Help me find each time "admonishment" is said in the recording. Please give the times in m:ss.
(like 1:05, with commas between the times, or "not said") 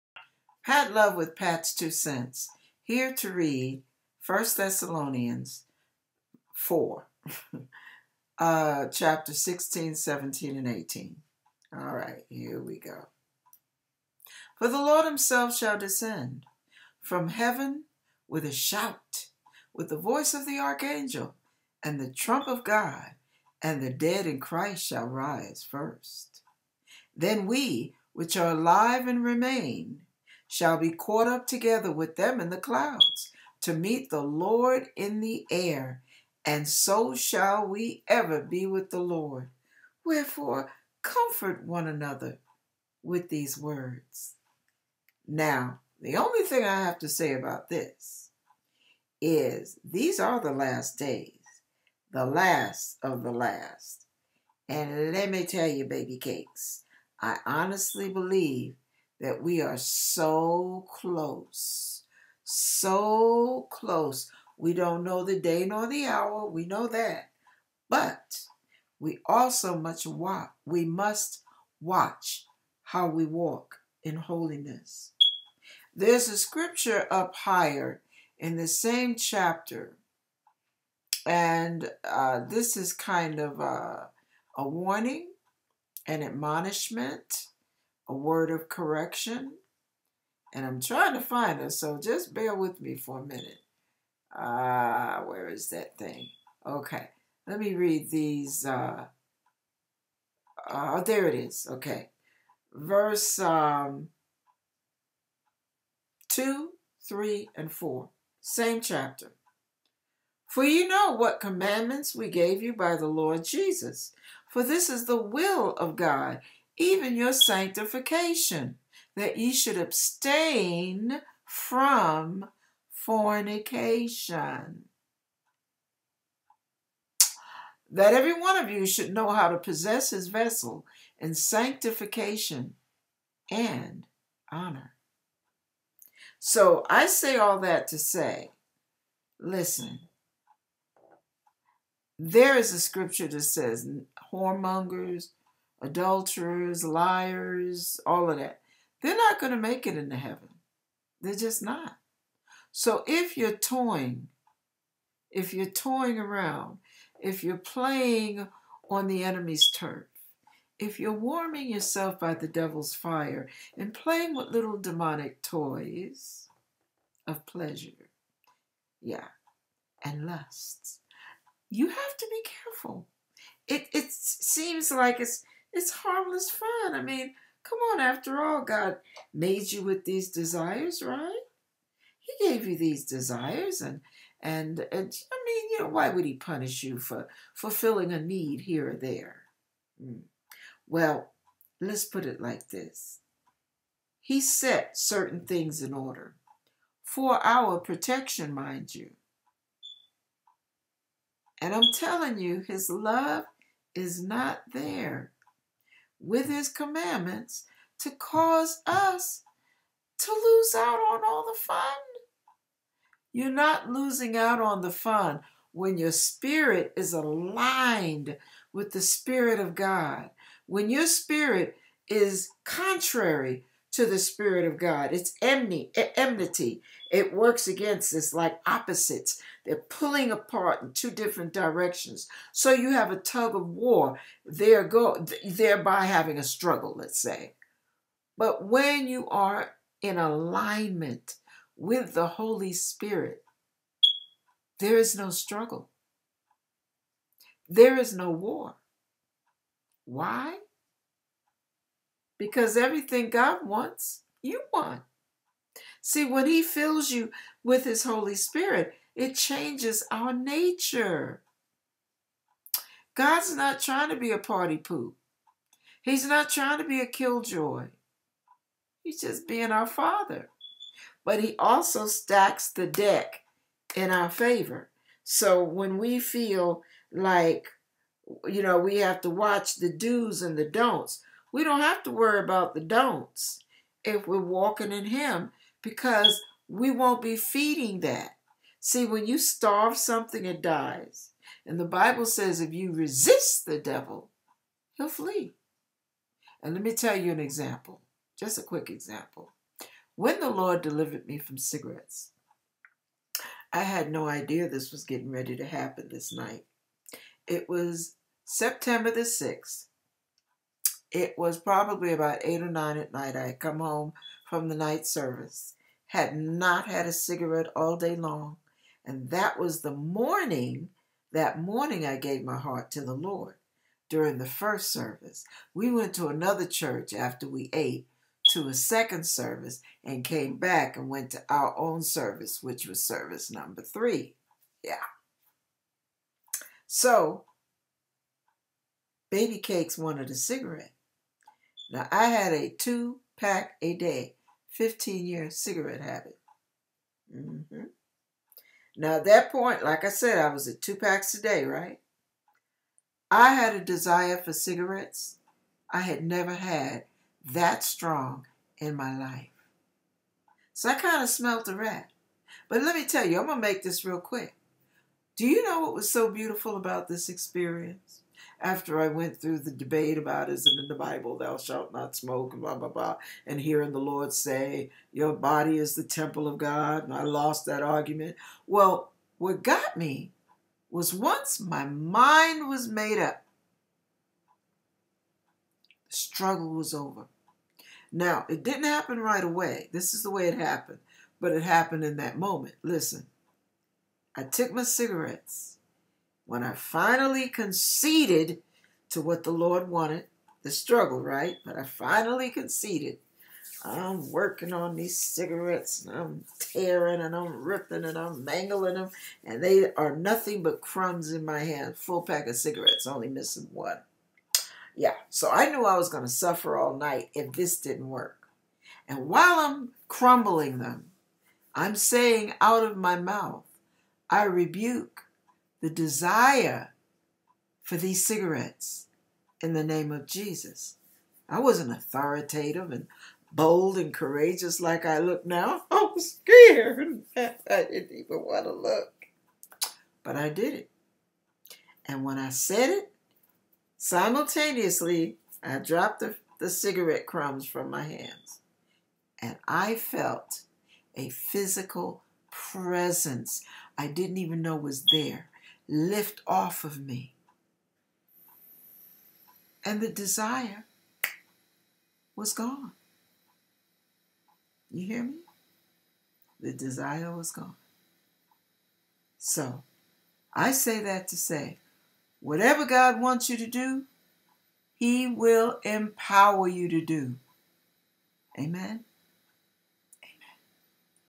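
1:26.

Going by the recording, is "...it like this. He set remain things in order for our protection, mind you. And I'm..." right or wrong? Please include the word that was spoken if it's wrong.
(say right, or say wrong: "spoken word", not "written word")
wrong: "certain", not "remain".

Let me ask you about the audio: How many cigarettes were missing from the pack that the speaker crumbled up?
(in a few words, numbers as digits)
1.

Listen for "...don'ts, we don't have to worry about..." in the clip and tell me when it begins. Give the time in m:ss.
4:40.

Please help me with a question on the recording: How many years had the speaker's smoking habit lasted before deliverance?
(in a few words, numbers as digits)
15.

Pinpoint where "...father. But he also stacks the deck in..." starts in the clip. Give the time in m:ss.
4:29.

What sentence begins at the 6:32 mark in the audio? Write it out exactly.
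Listen, I took my cigarettes when I finally conceded to what the Lord wanted, the struggle, right?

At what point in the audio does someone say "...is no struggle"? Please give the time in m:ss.
4:04.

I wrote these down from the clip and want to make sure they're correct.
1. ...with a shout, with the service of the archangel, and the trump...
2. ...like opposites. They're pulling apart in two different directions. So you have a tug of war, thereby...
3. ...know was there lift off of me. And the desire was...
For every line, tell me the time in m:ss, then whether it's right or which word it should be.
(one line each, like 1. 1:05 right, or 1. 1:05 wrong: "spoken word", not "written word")
1. 0:18 wrong: "voice", not "service"
2. 3:48 right
3. 7:34 right.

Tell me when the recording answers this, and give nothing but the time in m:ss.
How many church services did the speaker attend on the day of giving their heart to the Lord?
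5:33.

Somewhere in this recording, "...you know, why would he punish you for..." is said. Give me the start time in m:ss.
3:05.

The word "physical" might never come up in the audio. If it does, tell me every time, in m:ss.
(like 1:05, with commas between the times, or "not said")
7:31.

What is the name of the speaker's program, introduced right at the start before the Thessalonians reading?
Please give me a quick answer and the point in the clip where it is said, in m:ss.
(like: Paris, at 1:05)
Pat's Two Cents, at 0:01.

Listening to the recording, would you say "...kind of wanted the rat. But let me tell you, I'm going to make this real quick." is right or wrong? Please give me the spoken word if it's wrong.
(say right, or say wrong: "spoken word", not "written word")
wrong: "smelled", not "wanted".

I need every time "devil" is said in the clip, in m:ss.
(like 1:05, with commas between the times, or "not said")
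2:42, 4:53.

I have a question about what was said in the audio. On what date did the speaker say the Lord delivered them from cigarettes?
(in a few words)
September 6th.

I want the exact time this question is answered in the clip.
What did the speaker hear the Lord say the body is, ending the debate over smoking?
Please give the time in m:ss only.
6:15.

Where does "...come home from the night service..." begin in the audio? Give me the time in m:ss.
5:13.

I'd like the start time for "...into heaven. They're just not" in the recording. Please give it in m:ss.
2:29.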